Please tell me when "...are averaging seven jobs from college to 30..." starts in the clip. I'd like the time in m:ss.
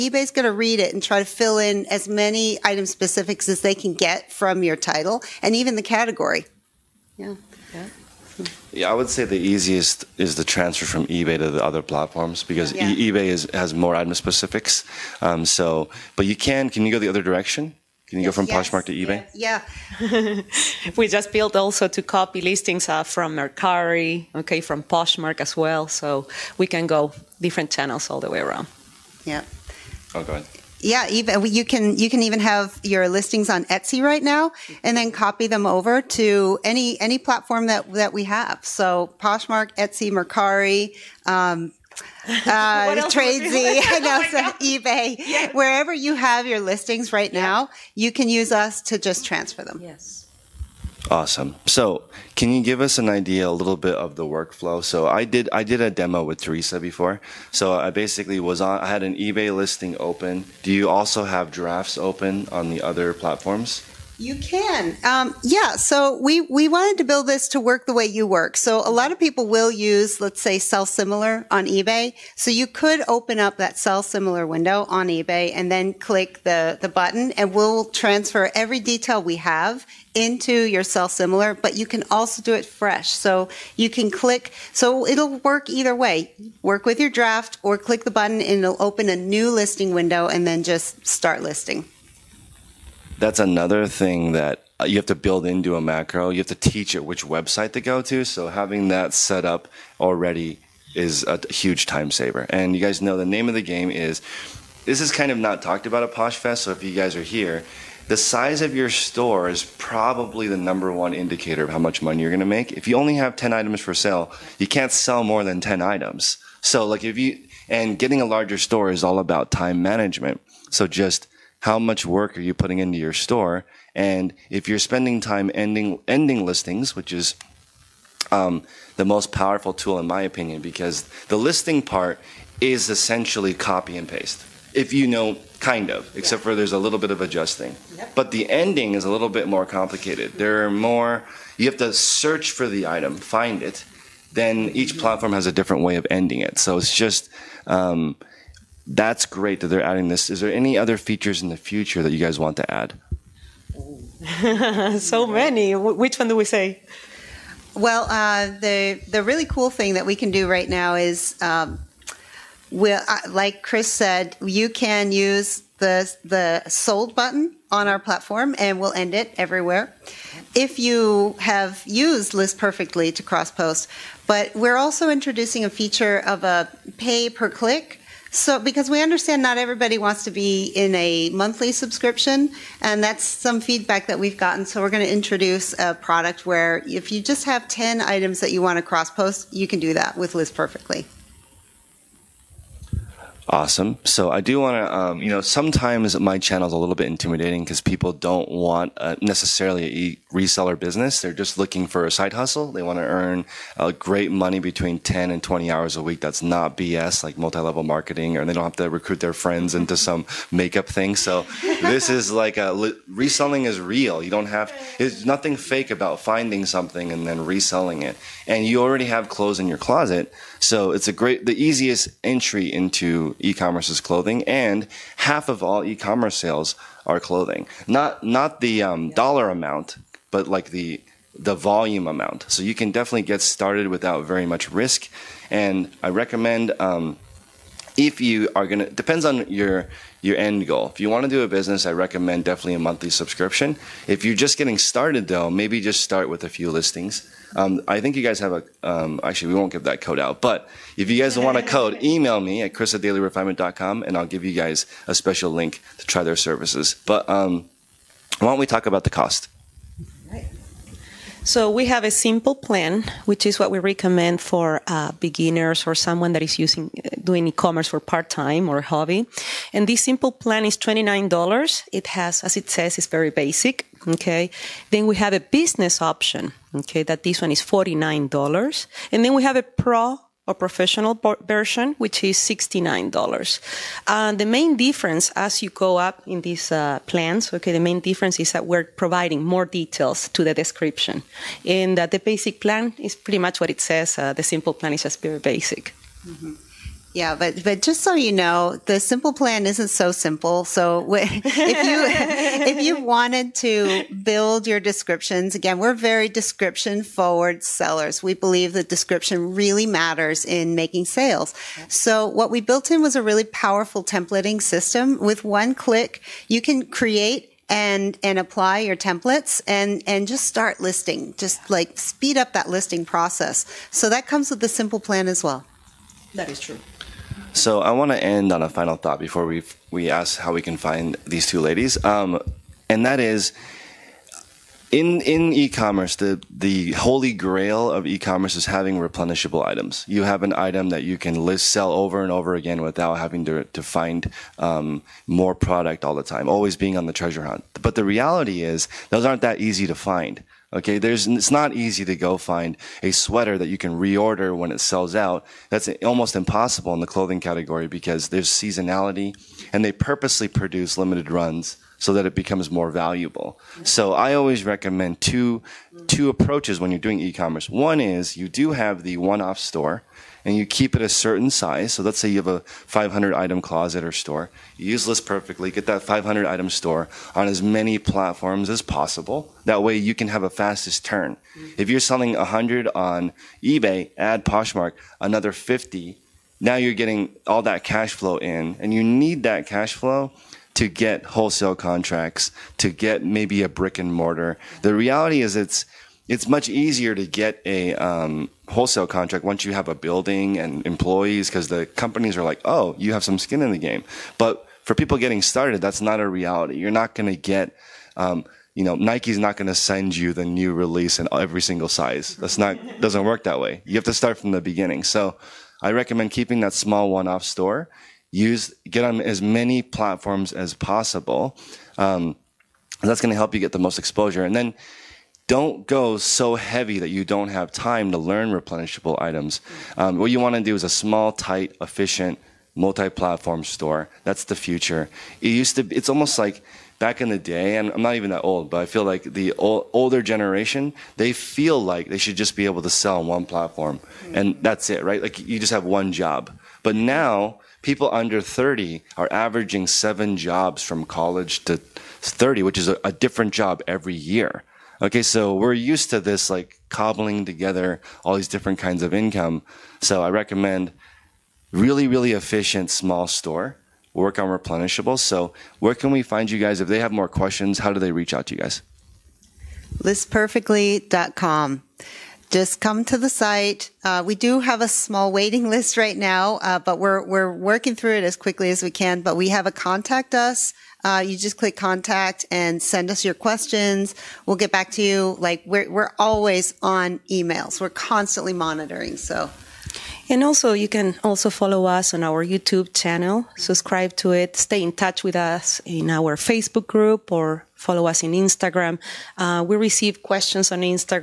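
7:29.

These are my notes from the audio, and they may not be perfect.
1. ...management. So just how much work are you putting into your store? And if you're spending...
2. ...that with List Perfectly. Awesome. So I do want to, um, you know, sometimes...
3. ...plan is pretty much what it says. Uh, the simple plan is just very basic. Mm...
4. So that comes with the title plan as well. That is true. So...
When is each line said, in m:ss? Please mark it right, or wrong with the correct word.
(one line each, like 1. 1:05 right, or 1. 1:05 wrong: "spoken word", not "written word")
1. 1:59 right
2. 3:09 right
3. 4:52 right
4. 5:23 wrong: "simple", not "title".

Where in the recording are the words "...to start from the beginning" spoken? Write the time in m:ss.
6:54.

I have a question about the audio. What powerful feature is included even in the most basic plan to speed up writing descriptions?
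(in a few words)
Templating system.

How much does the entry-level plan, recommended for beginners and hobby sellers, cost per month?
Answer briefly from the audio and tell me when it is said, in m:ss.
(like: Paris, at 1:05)
$29, at 4:30.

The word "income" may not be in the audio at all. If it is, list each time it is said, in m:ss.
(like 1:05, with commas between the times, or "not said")
7:39.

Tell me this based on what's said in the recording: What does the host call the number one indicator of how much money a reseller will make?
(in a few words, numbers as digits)
The size of your store.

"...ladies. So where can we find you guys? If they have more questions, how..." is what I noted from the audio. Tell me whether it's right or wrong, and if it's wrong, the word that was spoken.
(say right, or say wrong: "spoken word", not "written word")
wrong: "replenishables", not "ladies".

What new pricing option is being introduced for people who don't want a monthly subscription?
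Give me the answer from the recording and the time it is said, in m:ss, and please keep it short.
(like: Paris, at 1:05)
Pay per click, at 2:56.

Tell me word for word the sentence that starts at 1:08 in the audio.
So a lot of people will use, let's say, sell similar on eBay.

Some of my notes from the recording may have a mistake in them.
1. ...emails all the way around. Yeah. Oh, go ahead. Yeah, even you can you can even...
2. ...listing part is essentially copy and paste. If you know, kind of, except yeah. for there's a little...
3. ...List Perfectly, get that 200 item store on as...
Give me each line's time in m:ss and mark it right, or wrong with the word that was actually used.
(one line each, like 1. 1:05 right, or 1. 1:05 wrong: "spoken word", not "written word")
1. 0:27 wrong: "channels", not "emails"
2. 2:11 right
3. 6:15 wrong: "500", not "200".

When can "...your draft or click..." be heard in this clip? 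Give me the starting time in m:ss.
1:27.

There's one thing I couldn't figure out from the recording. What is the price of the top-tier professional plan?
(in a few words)
$69.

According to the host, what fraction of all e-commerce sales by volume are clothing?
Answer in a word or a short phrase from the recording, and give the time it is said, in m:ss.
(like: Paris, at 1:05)
Half, at 3:45.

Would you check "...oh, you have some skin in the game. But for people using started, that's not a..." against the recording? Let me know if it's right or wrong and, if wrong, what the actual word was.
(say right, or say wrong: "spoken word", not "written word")
wrong: "getting", not "using".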